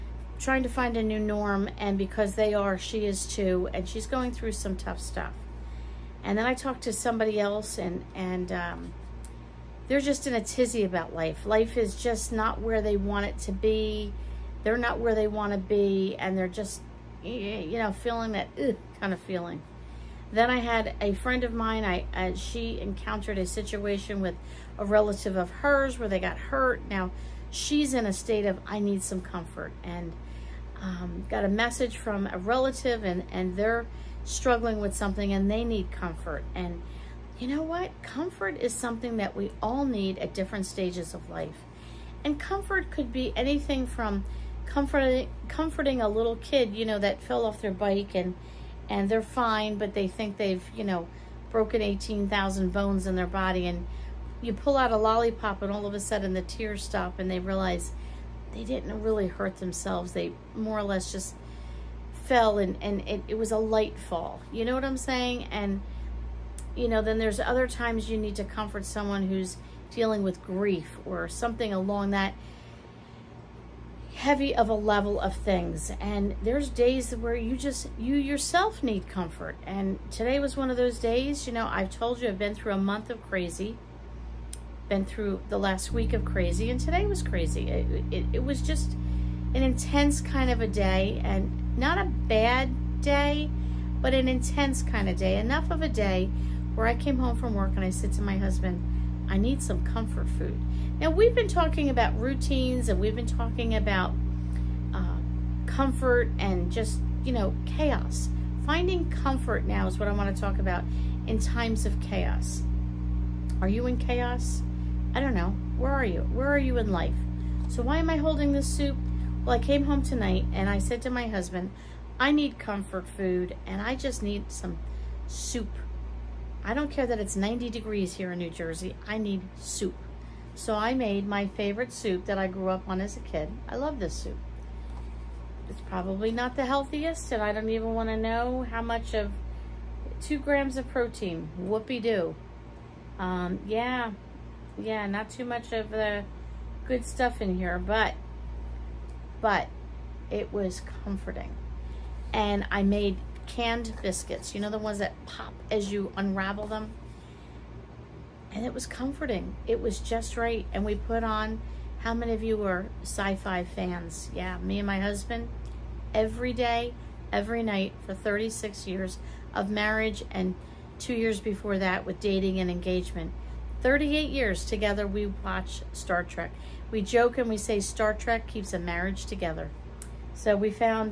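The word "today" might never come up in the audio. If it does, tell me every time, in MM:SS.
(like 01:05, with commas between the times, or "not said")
01:20, 01:26.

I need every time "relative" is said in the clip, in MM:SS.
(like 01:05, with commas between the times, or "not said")
00:24, 00:32.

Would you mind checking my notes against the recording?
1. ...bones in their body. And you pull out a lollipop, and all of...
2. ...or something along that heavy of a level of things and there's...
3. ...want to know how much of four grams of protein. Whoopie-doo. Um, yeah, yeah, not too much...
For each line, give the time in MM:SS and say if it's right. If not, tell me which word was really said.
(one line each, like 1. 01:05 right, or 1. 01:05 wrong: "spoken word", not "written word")
1. 00:52 right
2. 01:11 right
3. 02:17 wrong: "two", not "four".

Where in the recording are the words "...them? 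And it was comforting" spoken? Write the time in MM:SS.
02:36.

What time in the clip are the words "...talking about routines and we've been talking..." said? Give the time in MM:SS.
01:41.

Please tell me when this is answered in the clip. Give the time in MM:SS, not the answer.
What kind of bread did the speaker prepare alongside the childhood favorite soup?
02:33.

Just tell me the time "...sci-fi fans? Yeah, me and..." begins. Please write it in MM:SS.
02:43.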